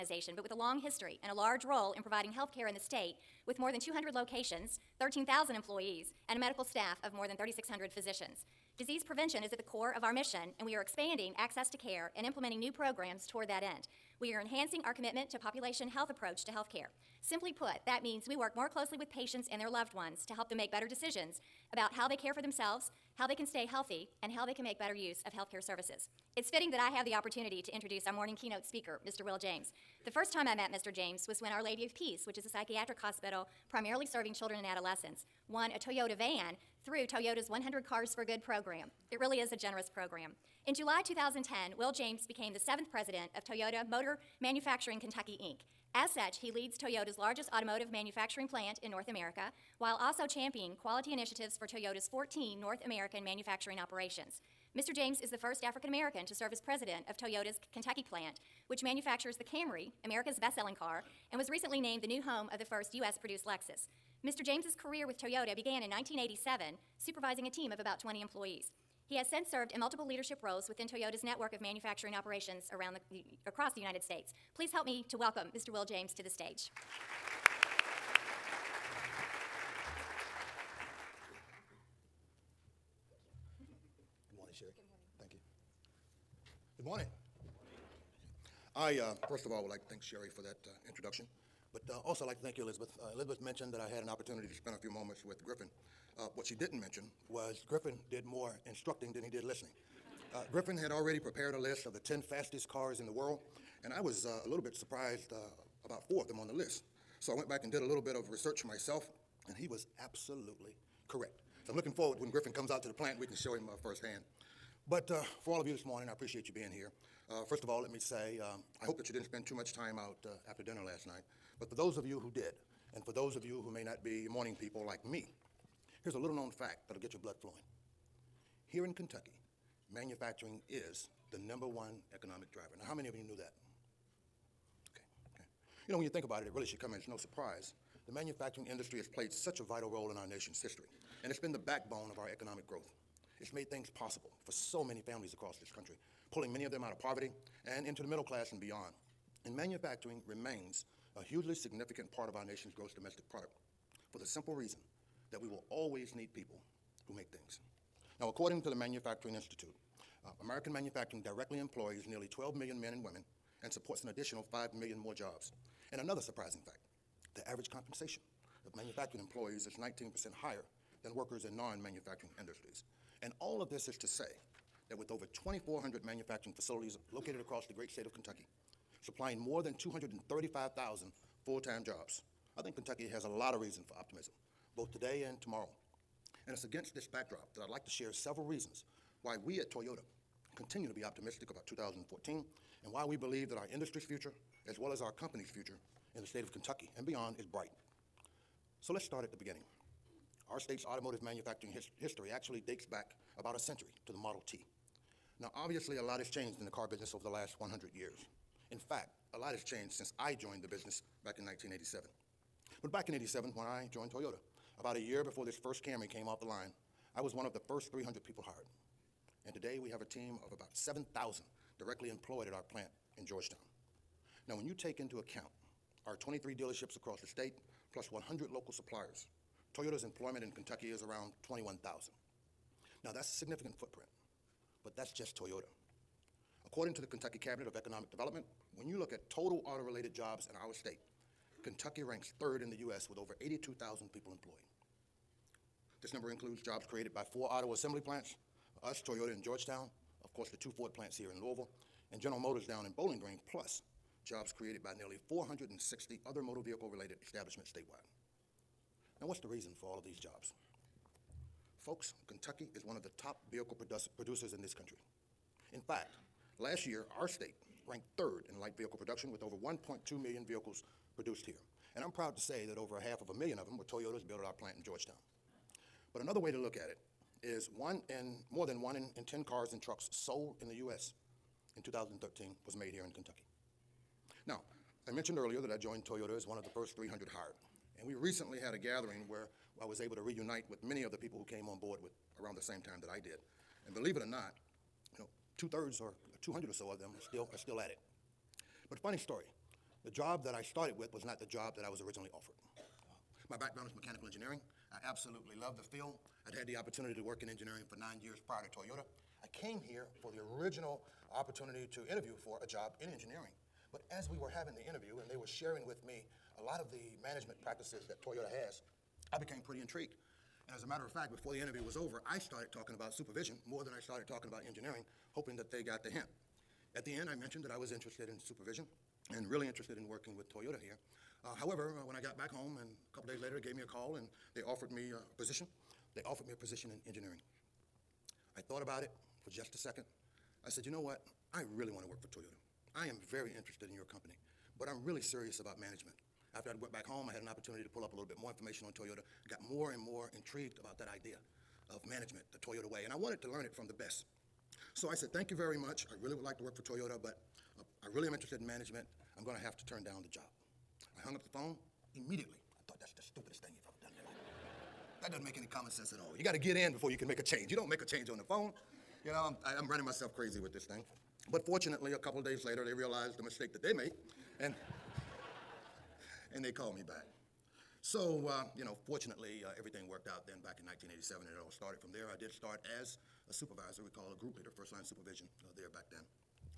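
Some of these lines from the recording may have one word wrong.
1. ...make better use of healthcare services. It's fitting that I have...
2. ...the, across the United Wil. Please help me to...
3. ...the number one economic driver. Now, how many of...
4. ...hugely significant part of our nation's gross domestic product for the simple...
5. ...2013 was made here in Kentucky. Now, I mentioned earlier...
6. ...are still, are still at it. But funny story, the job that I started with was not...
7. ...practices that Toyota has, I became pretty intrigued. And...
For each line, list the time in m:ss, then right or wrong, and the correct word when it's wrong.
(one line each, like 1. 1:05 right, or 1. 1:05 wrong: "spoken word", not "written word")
1. 0:24 right
2. 1:13 wrong: "States", not "Wil"
3. 2:11 right
4. 2:31 right
5. 4:41 right
6. 4:57 right
7. 5:17 right.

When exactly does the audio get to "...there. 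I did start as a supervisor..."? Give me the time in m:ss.
6:22.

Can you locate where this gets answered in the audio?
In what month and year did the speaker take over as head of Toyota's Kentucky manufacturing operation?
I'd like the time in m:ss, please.
0:40.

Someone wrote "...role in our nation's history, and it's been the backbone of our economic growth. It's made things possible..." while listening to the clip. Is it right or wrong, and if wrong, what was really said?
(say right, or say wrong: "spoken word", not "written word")
right.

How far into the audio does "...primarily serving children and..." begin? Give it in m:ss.
0:33.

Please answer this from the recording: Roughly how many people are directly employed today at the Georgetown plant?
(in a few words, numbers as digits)
7,000.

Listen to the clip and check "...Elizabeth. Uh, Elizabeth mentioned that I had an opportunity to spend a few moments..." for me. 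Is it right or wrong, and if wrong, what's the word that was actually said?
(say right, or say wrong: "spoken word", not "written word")
right.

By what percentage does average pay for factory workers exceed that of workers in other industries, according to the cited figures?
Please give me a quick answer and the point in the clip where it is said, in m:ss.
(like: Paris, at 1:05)
19%, at 2:49.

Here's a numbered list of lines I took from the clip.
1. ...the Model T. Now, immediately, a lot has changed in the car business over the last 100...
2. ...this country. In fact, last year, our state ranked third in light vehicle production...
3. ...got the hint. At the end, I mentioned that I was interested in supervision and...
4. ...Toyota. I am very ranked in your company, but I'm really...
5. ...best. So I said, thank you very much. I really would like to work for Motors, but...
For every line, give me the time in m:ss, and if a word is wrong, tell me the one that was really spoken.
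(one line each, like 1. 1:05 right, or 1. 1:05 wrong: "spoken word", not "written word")
1. 3:24 wrong: "obviously", not "immediately"
2. 4:24 right
3. 5:25 right
4. 5:42 wrong: "interested", not "ranked"
5. 5:53 wrong: "Toyota", not "Motors".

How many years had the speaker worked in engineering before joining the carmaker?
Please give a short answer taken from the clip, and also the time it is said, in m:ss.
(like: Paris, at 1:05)
9, at 5:07.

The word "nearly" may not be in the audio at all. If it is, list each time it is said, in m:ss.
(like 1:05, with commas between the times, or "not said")
2:42, 4:14.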